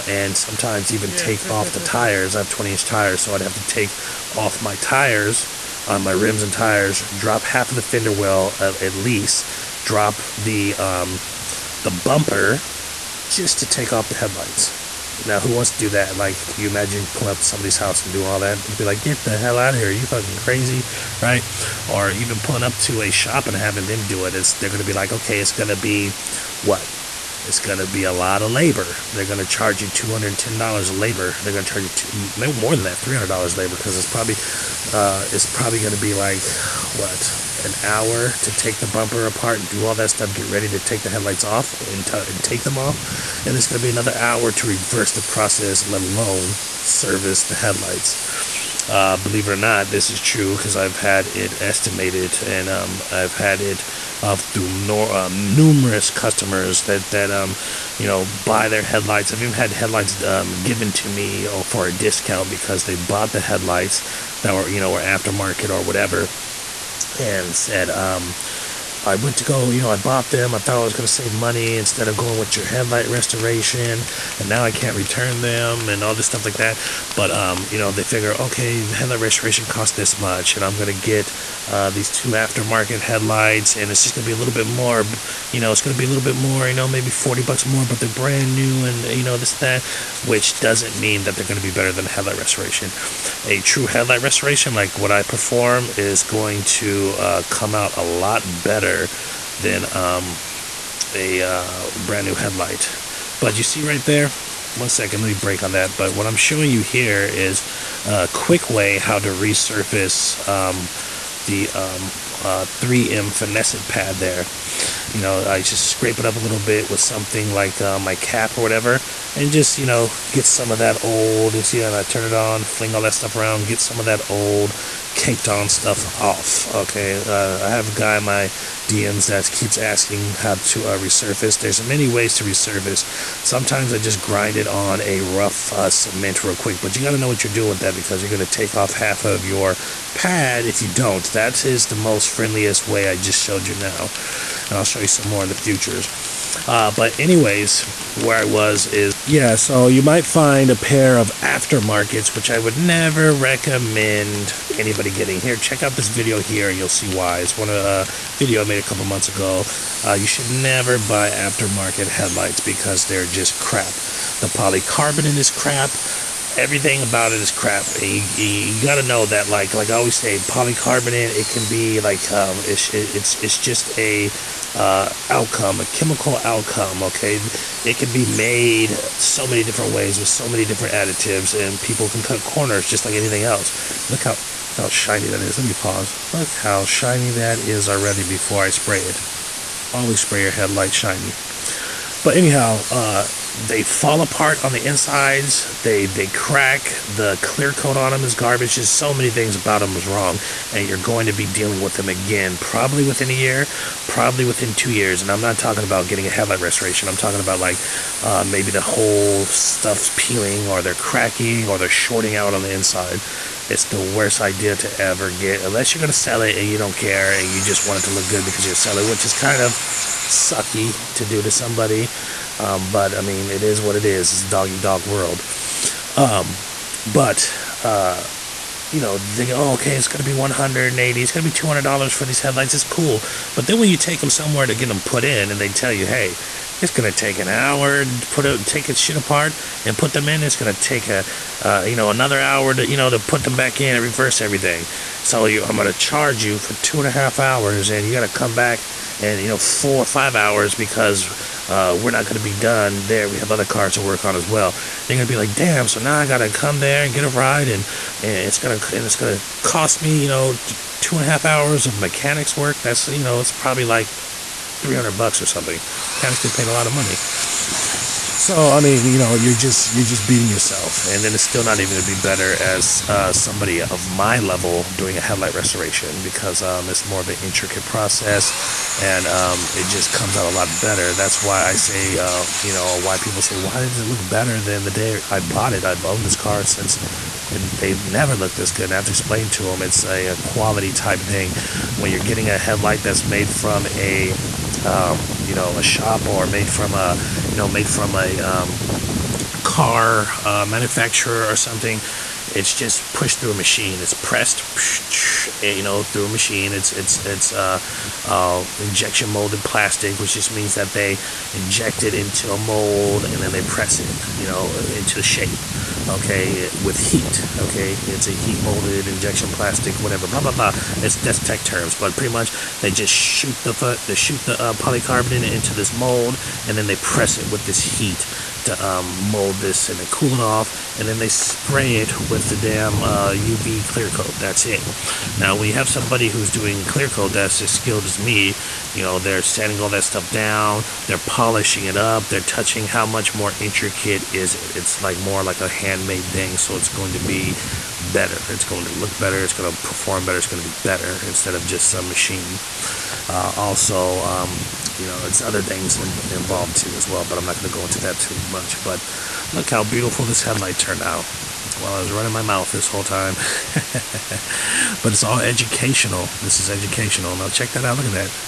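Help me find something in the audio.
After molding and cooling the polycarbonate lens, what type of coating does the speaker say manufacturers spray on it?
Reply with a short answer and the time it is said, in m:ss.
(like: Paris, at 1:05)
UV clear coat, at 5:33.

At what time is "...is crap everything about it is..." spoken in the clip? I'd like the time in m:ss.
2:45.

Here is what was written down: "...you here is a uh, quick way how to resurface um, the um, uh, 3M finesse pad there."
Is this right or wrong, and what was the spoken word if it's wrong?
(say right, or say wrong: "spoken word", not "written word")
right.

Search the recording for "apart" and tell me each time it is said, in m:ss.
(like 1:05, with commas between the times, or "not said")
0:39, 3:14, 3:59.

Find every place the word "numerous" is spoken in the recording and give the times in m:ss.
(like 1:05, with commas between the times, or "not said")
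0:55.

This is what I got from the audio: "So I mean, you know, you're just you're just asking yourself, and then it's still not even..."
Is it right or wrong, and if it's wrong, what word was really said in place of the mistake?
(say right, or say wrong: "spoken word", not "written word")
wrong: "beating", not "asking".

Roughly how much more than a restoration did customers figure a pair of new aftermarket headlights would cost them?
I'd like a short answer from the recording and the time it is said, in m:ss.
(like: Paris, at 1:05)
forty bucks, at 1:27.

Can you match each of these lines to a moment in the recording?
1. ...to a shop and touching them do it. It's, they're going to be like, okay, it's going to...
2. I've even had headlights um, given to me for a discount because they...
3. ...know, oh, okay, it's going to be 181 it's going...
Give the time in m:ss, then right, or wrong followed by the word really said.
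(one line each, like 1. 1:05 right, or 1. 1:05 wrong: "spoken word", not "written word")
1. 0:22 wrong: "having", not "touching"
2. 0:59 right
3. 3:49 wrong: "180", not "181".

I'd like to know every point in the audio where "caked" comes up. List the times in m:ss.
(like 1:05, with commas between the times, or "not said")
2:05.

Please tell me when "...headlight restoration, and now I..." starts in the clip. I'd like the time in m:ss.
1:12.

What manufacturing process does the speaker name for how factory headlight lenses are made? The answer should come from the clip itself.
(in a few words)
injection molded.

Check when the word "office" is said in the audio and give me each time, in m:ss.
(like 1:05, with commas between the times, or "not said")
not said.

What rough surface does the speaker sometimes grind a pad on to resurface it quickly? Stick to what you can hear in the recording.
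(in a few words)
cement.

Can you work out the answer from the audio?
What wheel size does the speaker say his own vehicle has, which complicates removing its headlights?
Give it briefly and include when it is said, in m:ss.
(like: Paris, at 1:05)
20 inch, at 0:02.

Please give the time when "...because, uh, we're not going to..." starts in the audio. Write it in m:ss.
4:10.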